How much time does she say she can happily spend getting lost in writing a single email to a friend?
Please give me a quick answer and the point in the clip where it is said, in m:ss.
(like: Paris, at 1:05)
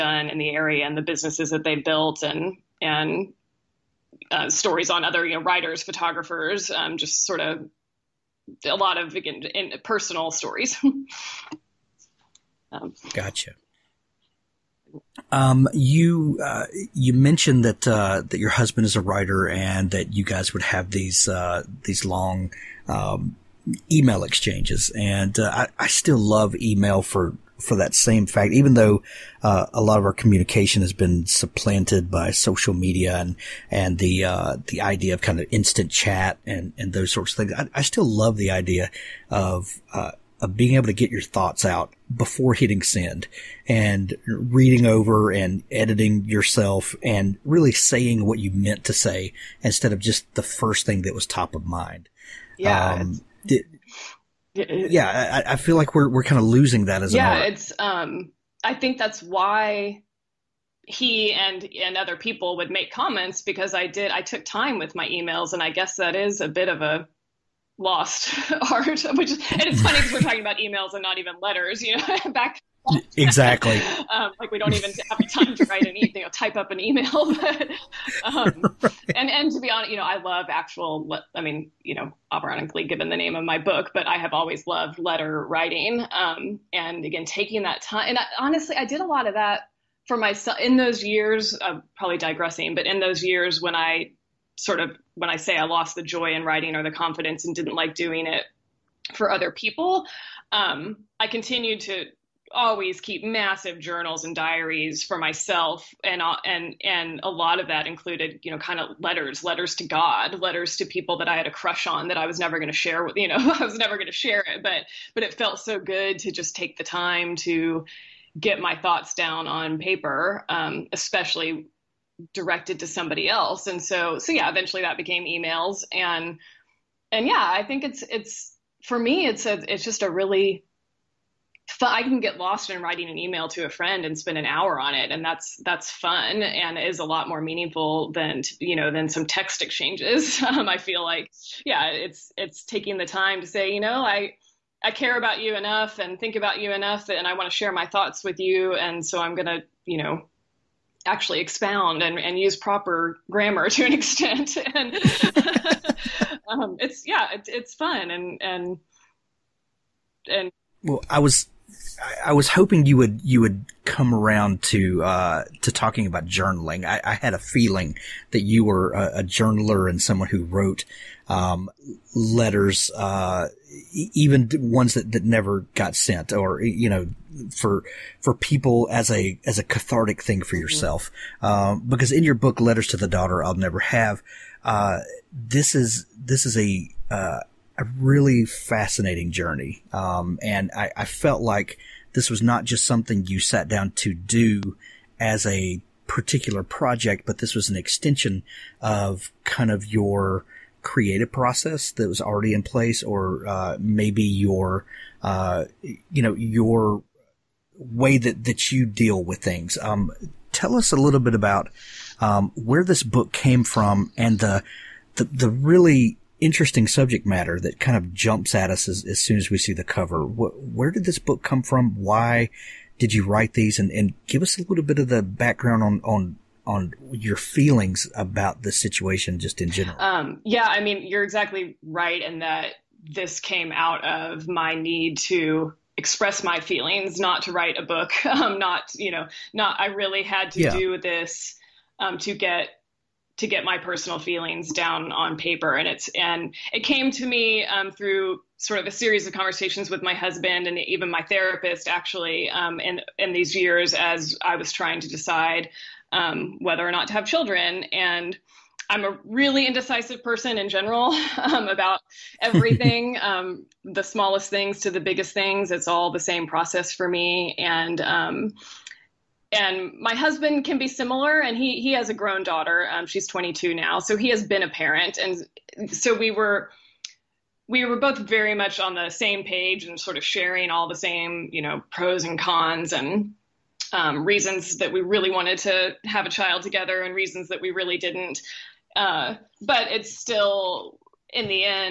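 An hour, at 2:14.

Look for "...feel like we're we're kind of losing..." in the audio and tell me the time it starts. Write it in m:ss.
0:55.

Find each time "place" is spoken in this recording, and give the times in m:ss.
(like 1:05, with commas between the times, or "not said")
3:22.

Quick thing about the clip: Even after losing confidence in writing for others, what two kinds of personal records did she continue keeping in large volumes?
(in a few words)
Journals and diaries.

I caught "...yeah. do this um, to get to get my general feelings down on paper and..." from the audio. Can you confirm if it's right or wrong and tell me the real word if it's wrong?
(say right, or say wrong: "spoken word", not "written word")
wrong: "personal", not "general".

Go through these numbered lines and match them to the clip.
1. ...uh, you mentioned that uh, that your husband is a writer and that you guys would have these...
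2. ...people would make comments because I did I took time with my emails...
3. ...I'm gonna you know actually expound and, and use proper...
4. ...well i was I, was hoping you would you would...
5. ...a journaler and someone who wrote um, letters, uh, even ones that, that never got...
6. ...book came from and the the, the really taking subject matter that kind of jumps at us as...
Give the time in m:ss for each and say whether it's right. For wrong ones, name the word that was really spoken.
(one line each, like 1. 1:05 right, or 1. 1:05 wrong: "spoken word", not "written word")
1. 0:16 right
2. 1:02 right
3. 2:29 right
4. 2:40 right
5. 2:49 right
6. 3:33 wrong: "interesting", not "taking".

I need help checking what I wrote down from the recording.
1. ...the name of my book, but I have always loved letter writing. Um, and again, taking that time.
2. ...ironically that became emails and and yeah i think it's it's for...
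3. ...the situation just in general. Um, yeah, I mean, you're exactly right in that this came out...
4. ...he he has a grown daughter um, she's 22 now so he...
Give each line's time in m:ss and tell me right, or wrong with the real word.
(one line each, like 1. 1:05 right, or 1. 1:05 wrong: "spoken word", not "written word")
1. 1:23 right
2. 2:04 wrong: "eventually", not "ironically"
3. 3:48 right
4. 4:31 right.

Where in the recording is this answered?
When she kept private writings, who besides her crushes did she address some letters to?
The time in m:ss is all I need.
1:49.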